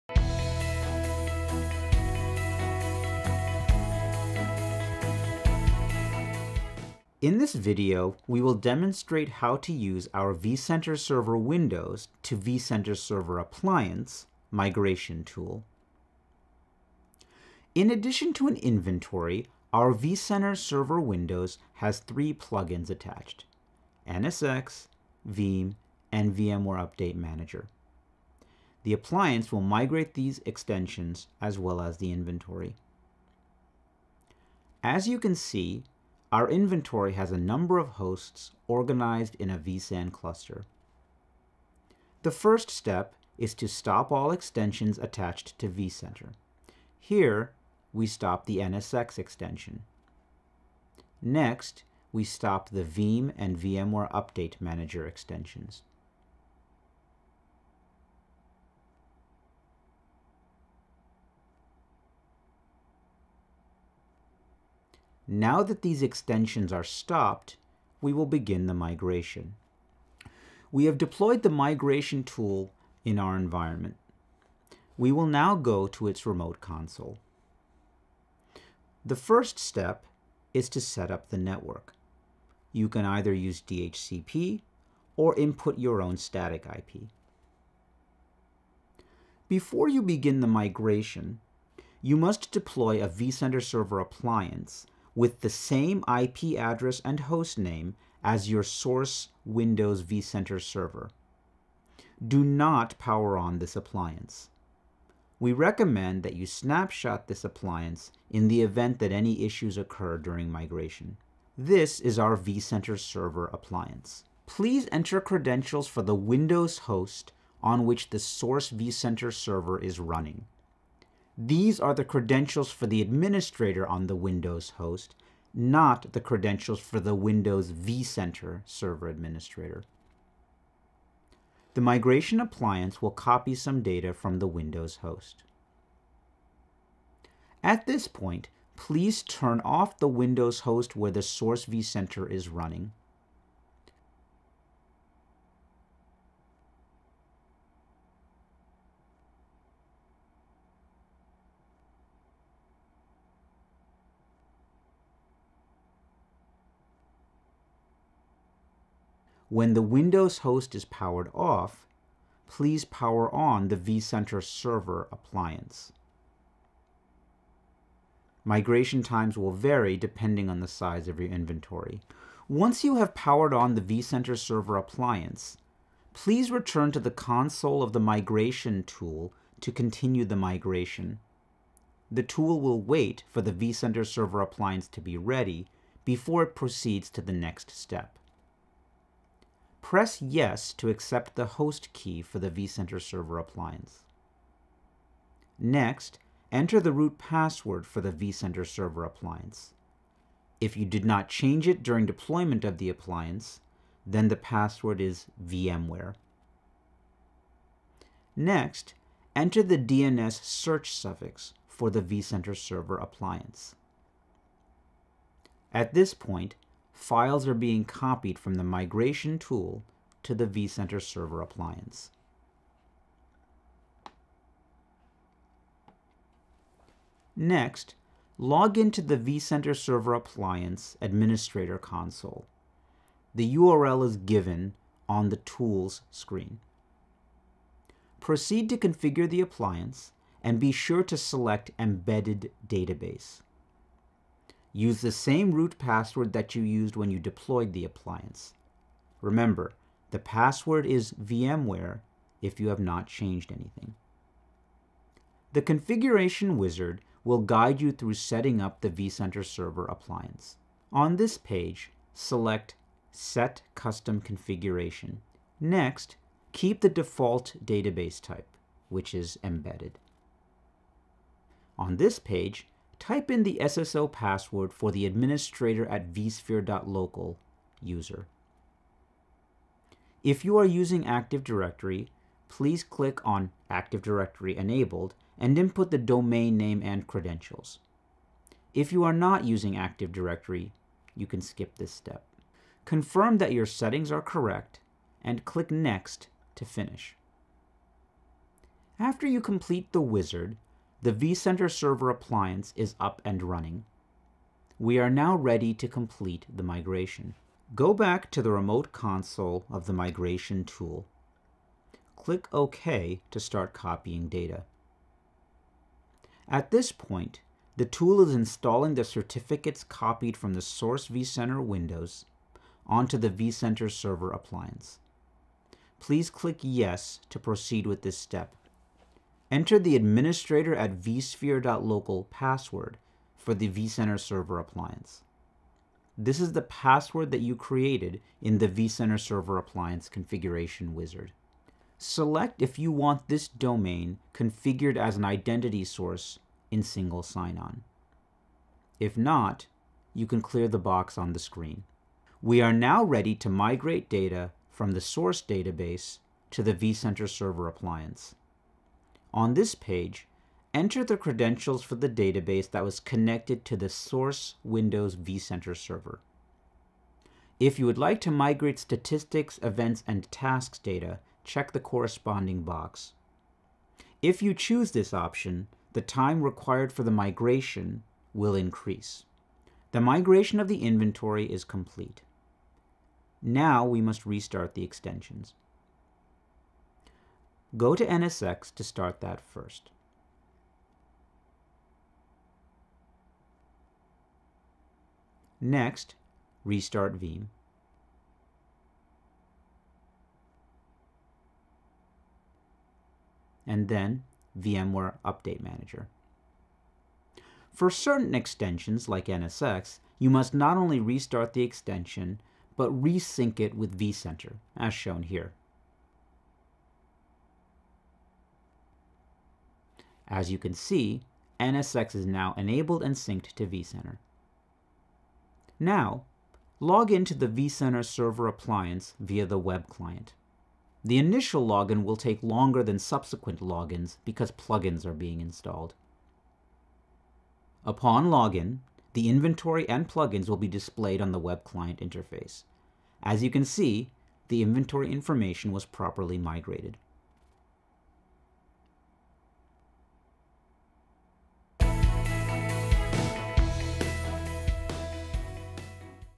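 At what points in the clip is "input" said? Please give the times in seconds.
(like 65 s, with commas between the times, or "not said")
85 s, 285 s.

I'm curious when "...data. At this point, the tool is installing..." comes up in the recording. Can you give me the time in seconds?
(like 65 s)
314 s.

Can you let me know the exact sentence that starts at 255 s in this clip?
The configuration wizard will guide you through setting up the vCenter Server appliance.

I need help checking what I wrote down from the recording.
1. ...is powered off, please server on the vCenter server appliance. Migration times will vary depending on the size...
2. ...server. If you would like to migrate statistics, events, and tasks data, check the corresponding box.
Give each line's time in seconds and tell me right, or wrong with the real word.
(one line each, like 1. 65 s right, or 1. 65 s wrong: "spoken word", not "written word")
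1. 160 s wrong: "power", not "server"
2. 365 s right.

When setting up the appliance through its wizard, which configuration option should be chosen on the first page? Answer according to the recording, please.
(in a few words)
Set Custom Configuration.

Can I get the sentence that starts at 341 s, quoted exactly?
Select if you want this domain configured as an identity source in single sign-on.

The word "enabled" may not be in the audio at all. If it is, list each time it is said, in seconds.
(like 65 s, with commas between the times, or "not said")
284 s, 422 s.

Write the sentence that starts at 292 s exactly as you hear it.
Confirm that your settings are correct and click Next to finish.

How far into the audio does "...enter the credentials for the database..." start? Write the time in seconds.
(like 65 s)
360 s.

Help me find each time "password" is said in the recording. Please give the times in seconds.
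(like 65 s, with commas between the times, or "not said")
197 s, 204 s, 245 s, 250 s, 274 s, 332 s, 336 s.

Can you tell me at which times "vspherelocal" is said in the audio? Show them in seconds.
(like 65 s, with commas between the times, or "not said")
276 s, 331 s.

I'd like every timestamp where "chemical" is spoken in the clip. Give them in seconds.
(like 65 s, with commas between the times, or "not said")
not said.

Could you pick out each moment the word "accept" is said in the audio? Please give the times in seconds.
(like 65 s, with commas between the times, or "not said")
190 s.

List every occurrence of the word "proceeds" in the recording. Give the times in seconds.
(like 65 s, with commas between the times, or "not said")
186 s, 238 s, 327 s.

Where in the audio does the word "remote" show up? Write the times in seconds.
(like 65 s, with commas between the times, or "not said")
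76 s, 308 s.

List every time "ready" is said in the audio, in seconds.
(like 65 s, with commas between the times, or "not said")
185 s, 305 s, 353 s.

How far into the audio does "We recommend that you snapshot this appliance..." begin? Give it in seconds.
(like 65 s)
105 s.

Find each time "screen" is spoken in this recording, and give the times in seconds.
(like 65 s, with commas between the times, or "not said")
236 s, 351 s.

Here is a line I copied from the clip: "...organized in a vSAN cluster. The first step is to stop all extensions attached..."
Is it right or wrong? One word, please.
right.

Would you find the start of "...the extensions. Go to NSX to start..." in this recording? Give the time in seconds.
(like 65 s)
384 s.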